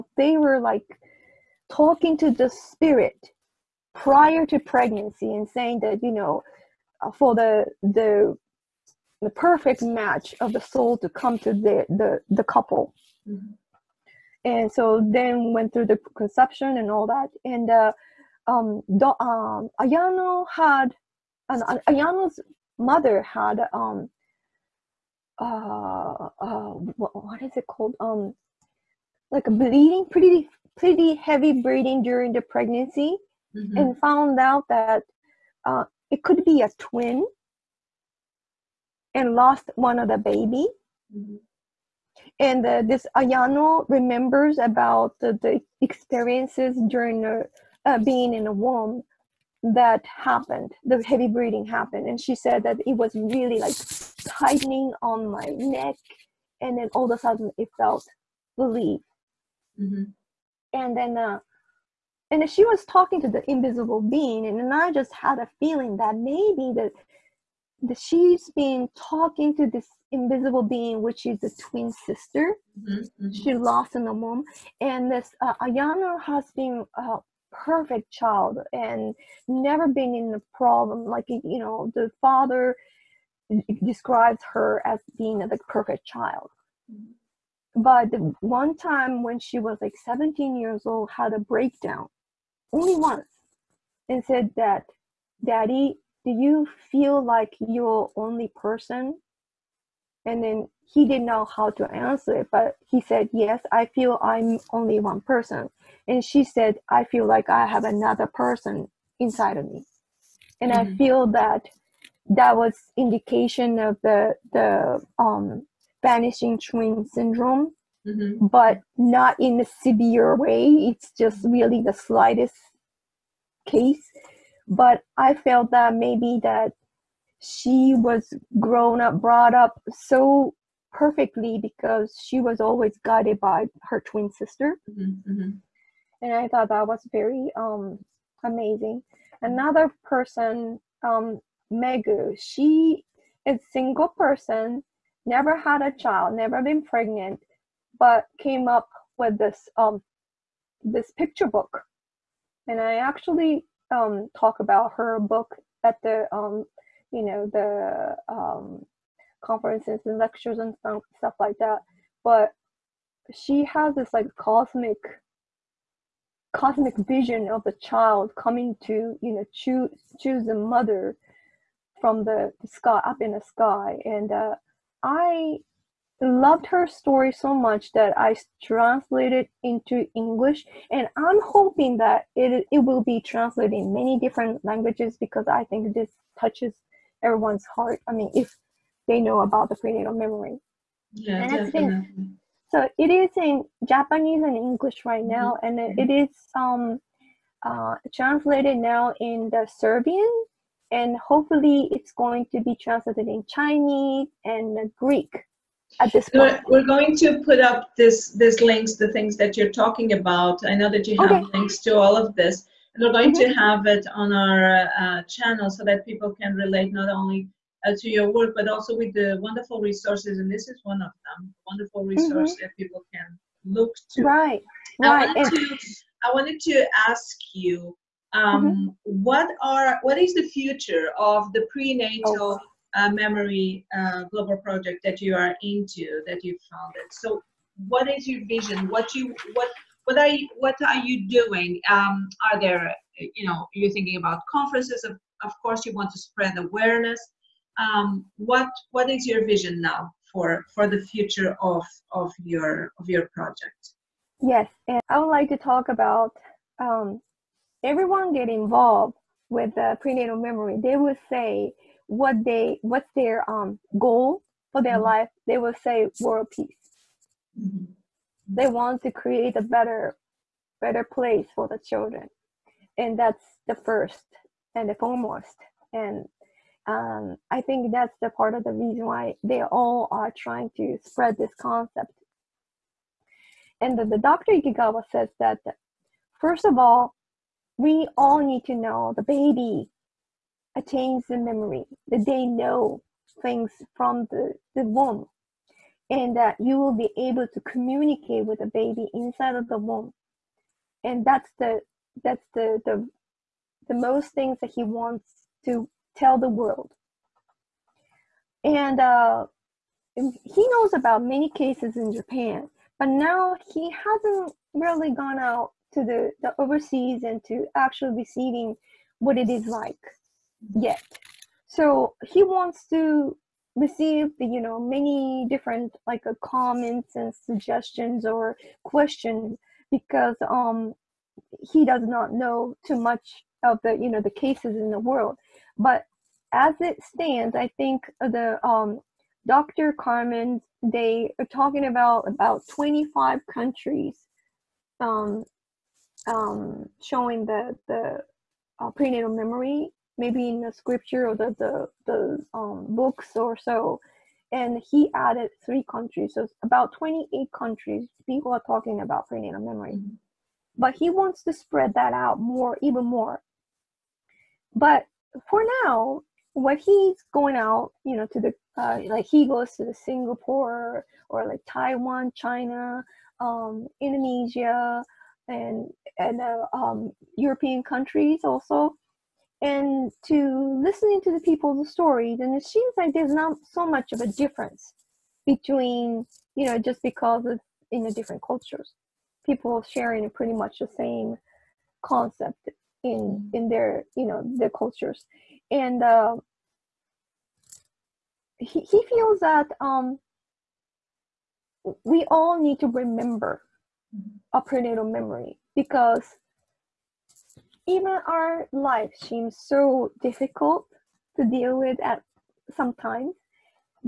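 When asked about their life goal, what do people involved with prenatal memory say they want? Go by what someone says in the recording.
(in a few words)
World peace.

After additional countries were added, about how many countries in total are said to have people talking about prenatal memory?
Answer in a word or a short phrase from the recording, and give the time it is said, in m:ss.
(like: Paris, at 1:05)
28, at 5:56.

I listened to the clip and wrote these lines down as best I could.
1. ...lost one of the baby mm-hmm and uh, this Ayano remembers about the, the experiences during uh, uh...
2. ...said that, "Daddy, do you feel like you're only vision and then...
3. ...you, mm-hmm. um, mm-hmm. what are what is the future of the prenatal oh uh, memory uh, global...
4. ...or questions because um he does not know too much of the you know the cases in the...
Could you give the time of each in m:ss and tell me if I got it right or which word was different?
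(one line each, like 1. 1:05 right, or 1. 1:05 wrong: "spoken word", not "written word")
1. 0:39 right
2. 1:34 wrong: "person", not "vision"
3. 3:47 right
4. 5:28 right.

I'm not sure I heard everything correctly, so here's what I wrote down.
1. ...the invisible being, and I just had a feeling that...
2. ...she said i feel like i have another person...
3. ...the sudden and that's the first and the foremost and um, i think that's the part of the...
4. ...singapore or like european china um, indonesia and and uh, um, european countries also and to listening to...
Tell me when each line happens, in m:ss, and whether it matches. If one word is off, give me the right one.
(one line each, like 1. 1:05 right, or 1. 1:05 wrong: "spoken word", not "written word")
1. 1:03 right
2. 1:46 right
3. 4:31 wrong: "children", not "sudden"
4. 6:09 wrong: "taiwan", not "european".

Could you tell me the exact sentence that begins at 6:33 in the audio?
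in their you know their cultures and uh, he, he feels that um we all need to remember our mm-hmm.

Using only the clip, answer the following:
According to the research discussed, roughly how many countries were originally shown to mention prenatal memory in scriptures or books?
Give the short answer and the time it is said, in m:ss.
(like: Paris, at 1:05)
25, at 5:42.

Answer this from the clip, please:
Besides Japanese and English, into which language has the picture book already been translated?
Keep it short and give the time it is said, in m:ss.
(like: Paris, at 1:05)
Serbian, at 3:19.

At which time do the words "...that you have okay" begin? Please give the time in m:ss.
3:30.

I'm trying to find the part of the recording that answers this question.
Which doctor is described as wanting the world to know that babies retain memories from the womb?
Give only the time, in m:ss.
4:44.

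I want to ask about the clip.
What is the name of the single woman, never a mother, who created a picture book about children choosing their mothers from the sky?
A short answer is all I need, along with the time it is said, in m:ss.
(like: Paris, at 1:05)
Megu, at 2:21.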